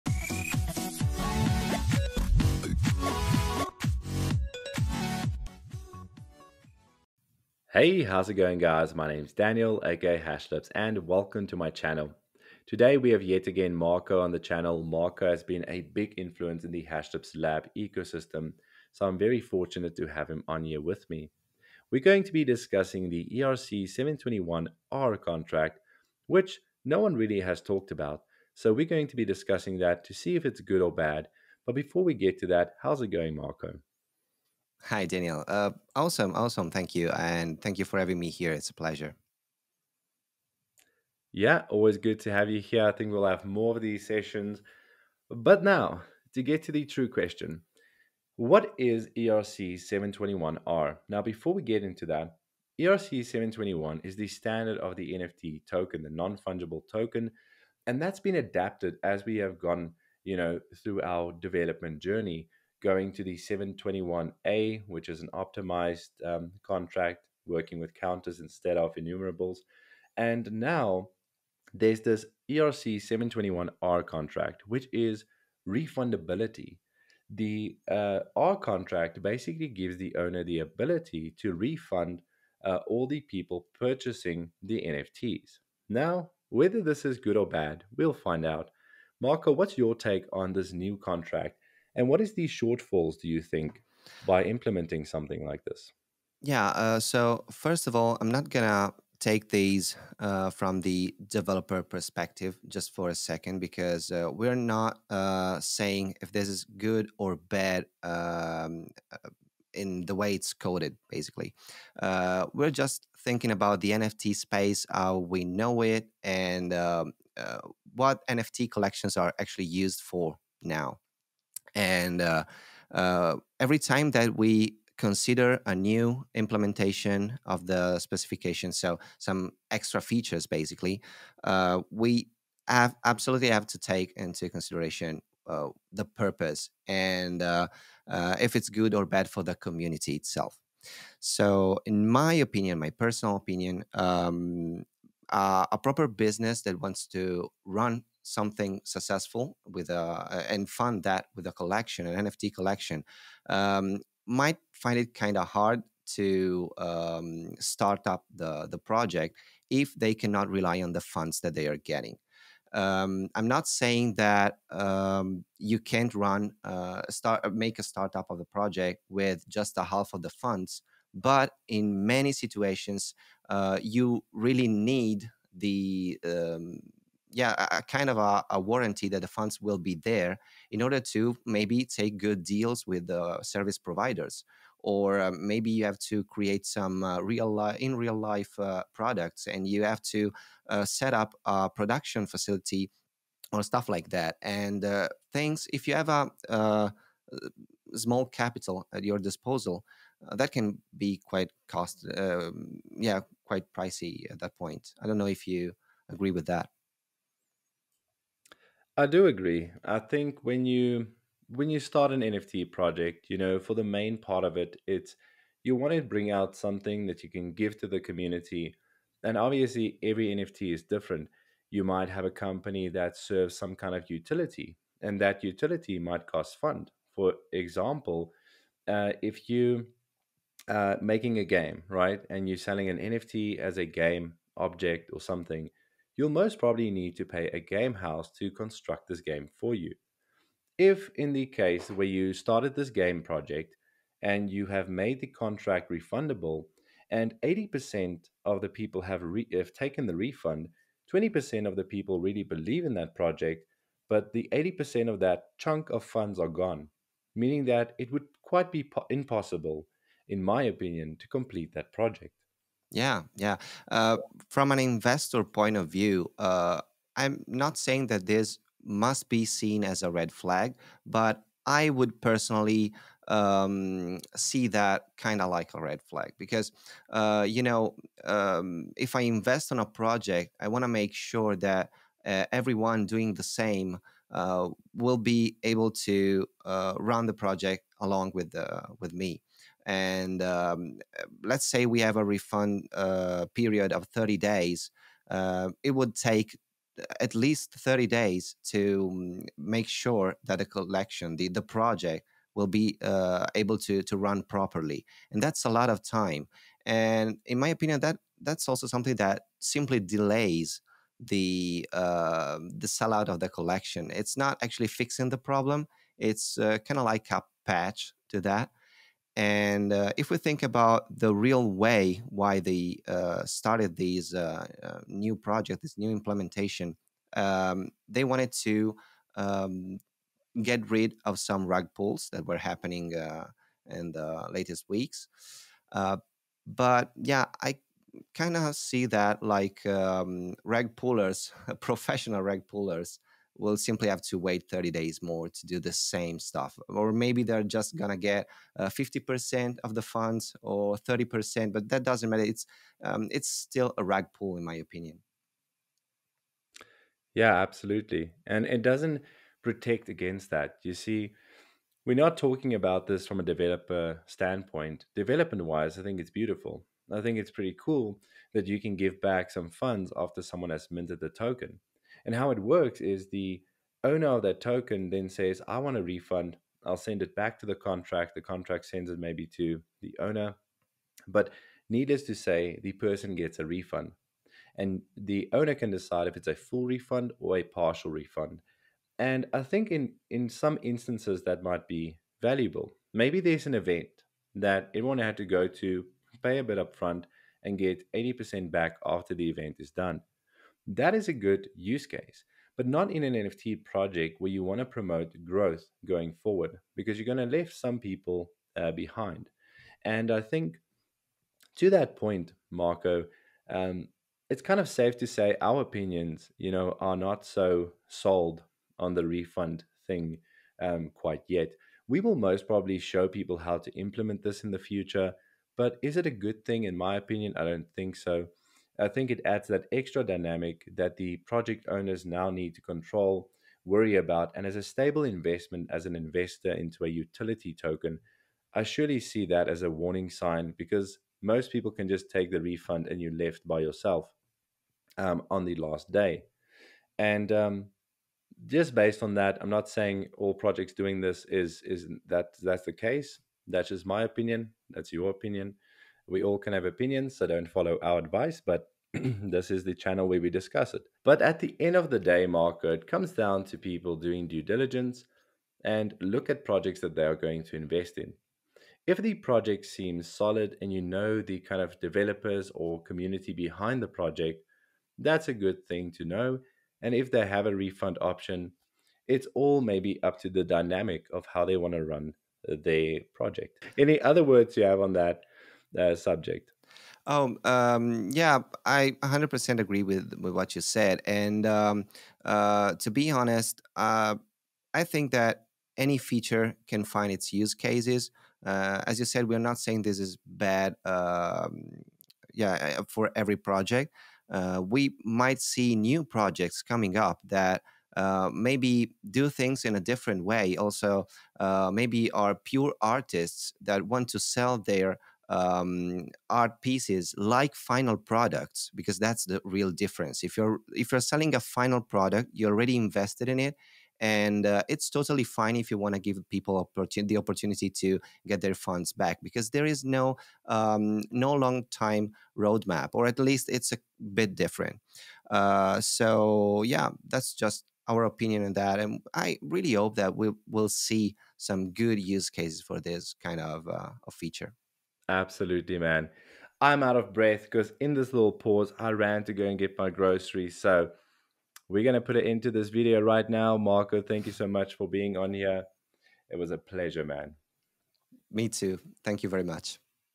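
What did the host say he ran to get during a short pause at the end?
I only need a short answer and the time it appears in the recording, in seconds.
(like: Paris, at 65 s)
groceries, at 550 s.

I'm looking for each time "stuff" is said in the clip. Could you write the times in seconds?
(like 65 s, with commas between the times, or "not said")
193 s, 346 s.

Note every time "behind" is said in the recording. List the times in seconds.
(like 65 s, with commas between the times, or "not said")
408 s, 473 s.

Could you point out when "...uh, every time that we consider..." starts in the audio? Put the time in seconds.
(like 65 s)
122 s.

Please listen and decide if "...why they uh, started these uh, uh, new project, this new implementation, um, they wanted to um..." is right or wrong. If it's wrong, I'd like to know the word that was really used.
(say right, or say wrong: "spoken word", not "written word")
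right.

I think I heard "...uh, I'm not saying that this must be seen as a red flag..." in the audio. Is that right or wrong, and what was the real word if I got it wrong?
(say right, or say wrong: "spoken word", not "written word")
right.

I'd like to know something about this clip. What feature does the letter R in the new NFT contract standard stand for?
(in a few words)
refundability.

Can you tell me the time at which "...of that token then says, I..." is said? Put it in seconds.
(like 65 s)
374 s.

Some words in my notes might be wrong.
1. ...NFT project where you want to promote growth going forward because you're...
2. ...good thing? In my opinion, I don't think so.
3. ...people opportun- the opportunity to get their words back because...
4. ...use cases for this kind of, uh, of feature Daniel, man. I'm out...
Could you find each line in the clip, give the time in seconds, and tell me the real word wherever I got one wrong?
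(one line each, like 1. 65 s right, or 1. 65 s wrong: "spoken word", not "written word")
1. 403 s right
2. 426 s right
3. 526 s wrong: "funds", not "words"
4. 542 s wrong: "Absolutely", not "Daniel".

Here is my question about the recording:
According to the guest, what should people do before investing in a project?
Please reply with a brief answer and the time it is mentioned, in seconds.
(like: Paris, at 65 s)
due diligence, at 464 s.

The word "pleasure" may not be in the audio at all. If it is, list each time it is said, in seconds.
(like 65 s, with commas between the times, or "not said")
38 s, 556 s.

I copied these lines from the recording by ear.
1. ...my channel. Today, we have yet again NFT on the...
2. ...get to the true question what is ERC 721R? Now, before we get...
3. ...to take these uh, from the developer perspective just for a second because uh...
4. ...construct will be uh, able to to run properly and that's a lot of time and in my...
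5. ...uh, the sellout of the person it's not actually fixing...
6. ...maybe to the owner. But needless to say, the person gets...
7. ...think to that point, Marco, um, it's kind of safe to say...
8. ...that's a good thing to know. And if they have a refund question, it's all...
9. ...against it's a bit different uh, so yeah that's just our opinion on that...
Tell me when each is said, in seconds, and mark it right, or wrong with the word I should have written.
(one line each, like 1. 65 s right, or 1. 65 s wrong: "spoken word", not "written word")
1. 11 s wrong: "Marco", not "NFT"
2. 46 s right
3. 98 s right
4. 301 s wrong: "project", not "construct"
5. 311 s wrong: "collection", not "person"
6. 379 s right
7. 410 s right
8. 475 s wrong: "option", not "question"
9. 533 s wrong: "least", not "against".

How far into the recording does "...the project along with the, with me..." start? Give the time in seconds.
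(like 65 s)
287 s.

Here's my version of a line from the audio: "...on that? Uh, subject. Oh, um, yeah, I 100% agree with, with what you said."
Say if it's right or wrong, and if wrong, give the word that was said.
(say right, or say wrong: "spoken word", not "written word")
right.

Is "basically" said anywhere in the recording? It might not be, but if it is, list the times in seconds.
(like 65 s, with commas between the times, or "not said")
79 s, 111 s, 130 s.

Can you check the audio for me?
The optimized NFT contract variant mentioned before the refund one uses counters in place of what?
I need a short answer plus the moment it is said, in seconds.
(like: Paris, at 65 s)
enumerables, at 68 s.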